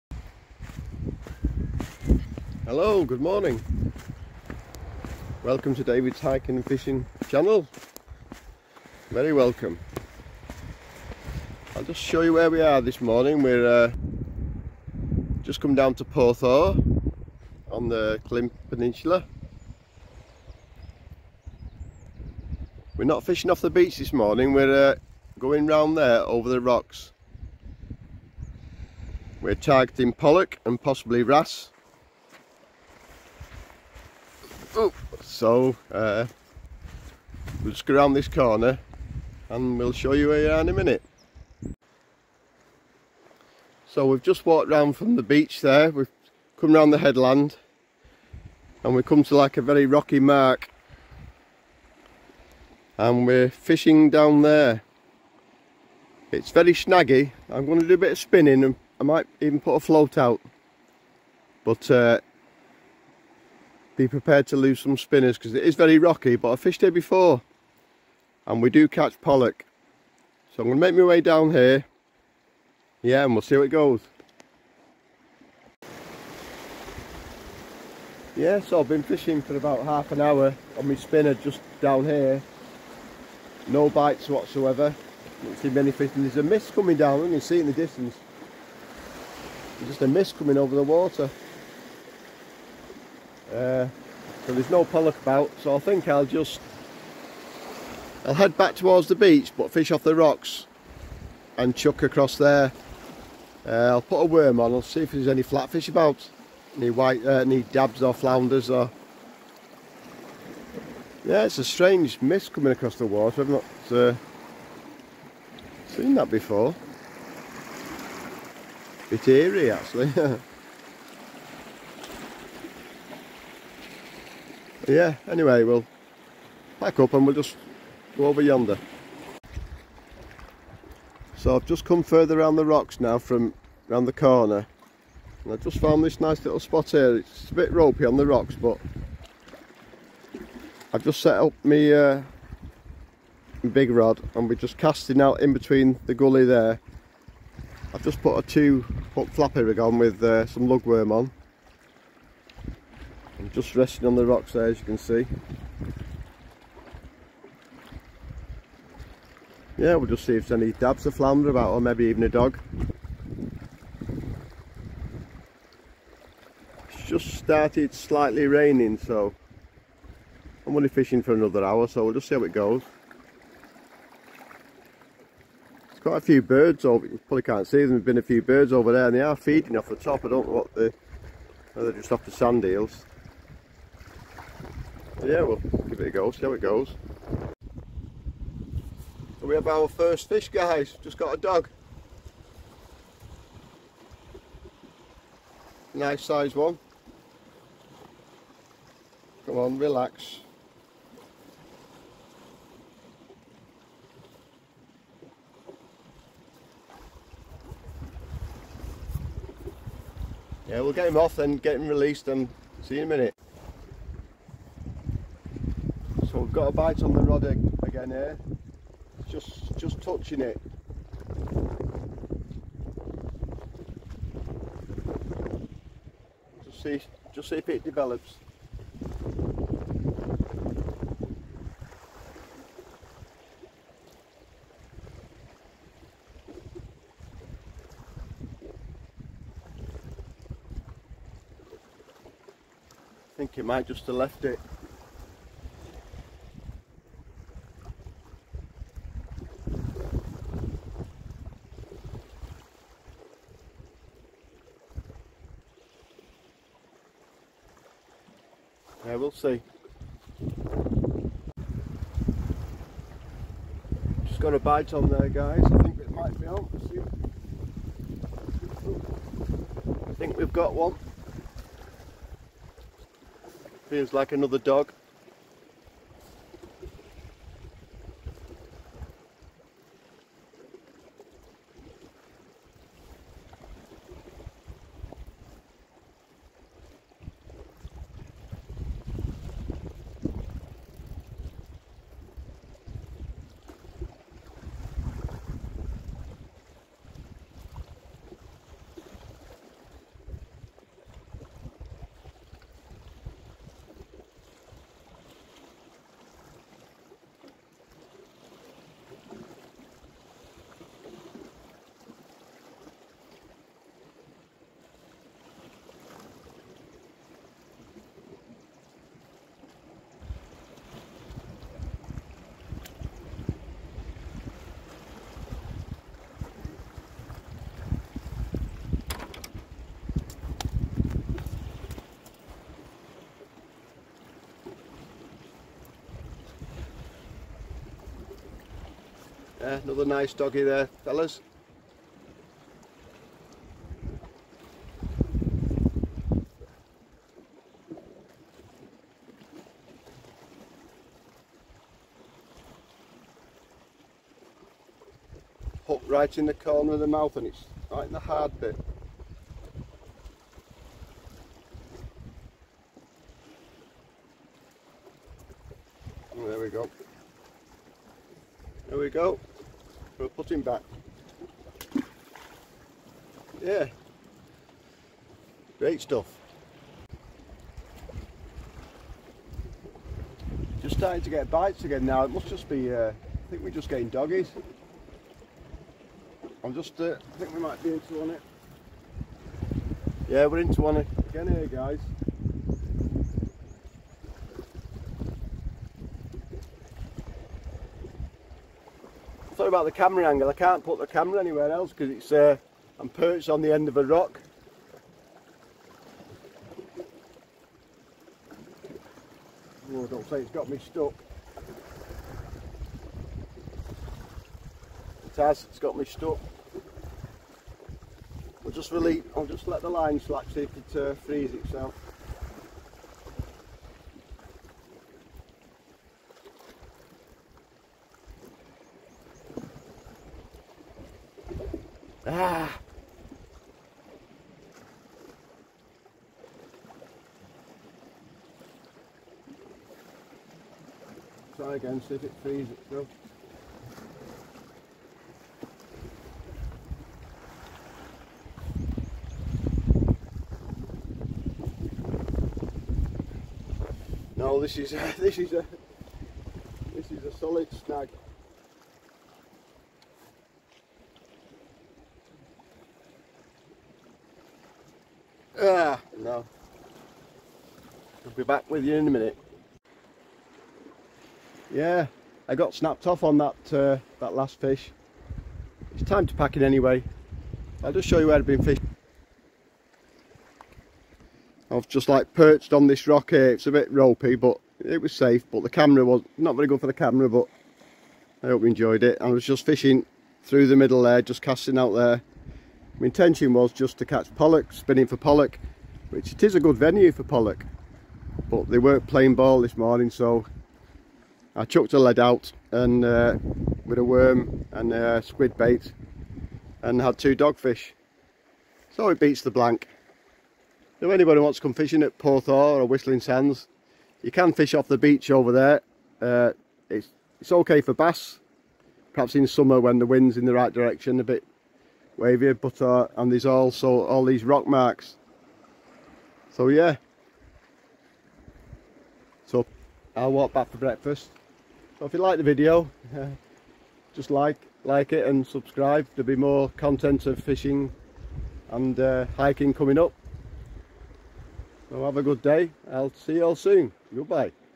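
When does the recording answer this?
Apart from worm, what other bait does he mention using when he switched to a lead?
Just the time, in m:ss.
8:25.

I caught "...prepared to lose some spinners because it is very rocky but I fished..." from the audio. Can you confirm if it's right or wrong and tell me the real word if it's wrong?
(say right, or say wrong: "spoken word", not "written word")
right.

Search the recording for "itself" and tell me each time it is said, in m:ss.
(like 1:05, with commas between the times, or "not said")
7:01, 7:22.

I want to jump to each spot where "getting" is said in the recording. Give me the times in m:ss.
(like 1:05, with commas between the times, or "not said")
6:23.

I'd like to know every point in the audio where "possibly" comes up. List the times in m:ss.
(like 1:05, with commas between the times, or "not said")
0:30.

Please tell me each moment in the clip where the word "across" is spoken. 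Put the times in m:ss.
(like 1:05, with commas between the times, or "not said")
1:42, 1:52.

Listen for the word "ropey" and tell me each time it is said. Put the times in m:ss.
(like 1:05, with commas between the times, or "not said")
2:17, 8:03.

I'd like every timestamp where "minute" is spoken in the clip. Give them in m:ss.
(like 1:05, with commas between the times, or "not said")
0:40, 3:33, 7:49.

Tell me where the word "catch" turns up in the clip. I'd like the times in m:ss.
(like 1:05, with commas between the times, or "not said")
1:08, 8:14.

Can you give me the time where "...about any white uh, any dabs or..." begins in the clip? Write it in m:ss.
1:45.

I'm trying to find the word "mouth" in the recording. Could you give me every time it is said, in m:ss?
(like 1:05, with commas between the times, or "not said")
5:57.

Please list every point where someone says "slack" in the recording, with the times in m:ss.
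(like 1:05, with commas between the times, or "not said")
7:00.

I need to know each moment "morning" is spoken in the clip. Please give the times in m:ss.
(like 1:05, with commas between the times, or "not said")
0:03, 0:13, 0:24, 8:19.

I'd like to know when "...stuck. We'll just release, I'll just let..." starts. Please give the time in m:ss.
6:56.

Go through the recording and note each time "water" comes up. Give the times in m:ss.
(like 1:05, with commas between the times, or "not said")
1:30, 1:53.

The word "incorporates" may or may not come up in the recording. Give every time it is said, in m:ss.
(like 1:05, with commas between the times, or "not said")
not said.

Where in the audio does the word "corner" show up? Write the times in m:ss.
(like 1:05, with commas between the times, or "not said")
0:38, 2:14, 5:56.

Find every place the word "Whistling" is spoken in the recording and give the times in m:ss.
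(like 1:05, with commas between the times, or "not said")
8:32.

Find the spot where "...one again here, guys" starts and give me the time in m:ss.
6:30.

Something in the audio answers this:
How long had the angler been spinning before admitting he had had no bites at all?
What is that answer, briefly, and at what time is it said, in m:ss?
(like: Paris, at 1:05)
half an hour, at 1:19.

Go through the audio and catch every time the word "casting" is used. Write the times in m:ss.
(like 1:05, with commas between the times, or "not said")
2:24, 8:11.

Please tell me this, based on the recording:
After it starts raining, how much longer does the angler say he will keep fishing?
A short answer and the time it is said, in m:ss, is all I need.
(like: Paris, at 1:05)
another hour, at 2:51.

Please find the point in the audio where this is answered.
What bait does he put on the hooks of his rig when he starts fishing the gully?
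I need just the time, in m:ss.
2:30.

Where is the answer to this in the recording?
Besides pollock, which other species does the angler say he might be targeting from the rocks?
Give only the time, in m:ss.
0:31.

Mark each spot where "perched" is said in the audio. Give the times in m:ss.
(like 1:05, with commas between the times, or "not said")
6:43, 8:02.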